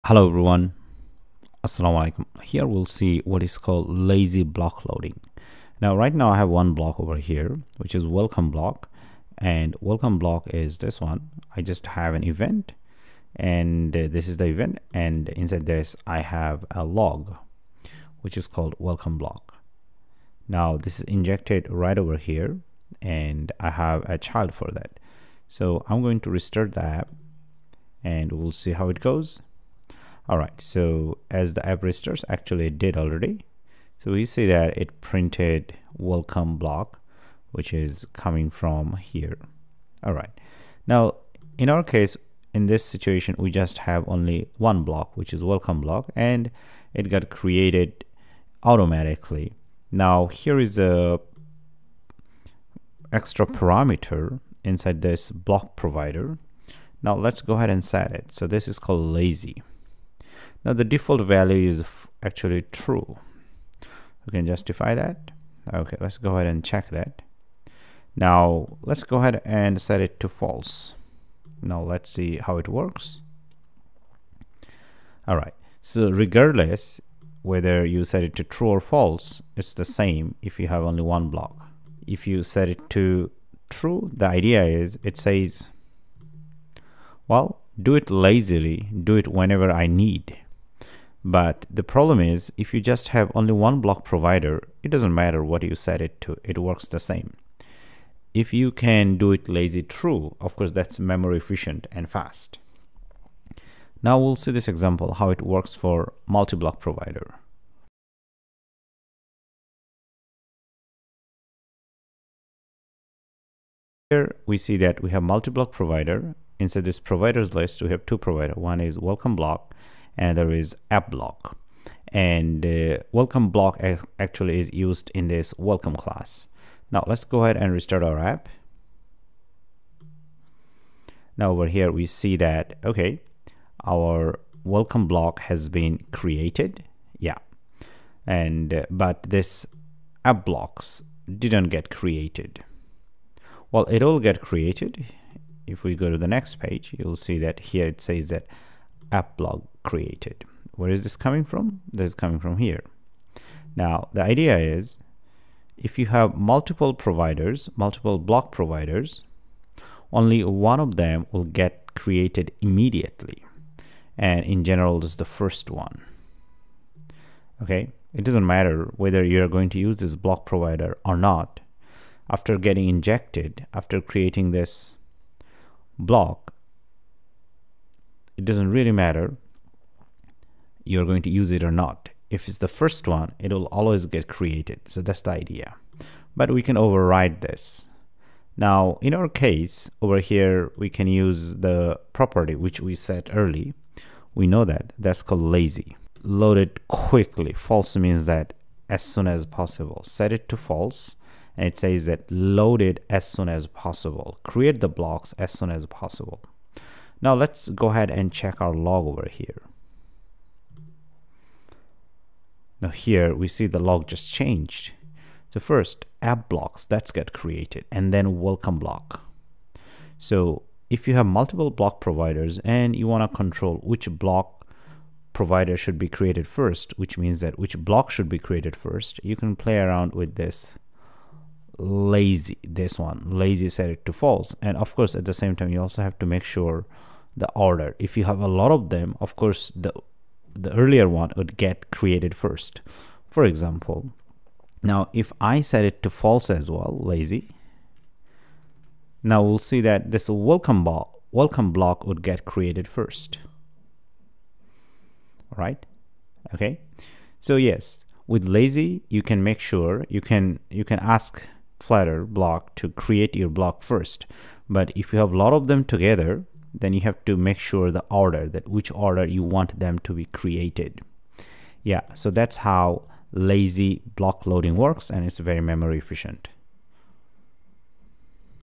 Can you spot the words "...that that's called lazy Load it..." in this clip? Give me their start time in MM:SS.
03:14.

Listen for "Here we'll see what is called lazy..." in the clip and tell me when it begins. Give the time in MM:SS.
00:02.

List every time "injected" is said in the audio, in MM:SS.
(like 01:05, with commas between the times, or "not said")
00:21, 02:52.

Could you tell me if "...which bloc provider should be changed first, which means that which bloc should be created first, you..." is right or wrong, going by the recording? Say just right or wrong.
wrong.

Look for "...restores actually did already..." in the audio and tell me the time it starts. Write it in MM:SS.
00:31.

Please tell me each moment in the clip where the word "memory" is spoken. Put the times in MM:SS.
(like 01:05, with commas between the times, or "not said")
01:40, 04:35.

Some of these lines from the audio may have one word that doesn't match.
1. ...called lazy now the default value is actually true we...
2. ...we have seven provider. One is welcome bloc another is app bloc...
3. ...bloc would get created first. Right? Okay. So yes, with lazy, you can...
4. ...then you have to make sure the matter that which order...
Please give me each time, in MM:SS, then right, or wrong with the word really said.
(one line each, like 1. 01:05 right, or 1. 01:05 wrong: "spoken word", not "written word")
1. 00:58 right
2. 01:57 wrong: "two", not "seven"
3. 04:11 right
4. 04:26 wrong: "order", not "matter".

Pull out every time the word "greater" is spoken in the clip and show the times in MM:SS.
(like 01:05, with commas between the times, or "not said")
not said.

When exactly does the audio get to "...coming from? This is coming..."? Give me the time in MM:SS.
02:31.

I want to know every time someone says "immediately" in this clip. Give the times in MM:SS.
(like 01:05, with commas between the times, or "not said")
02:42.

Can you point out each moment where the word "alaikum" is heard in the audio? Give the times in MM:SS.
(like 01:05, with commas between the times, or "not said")
00:02.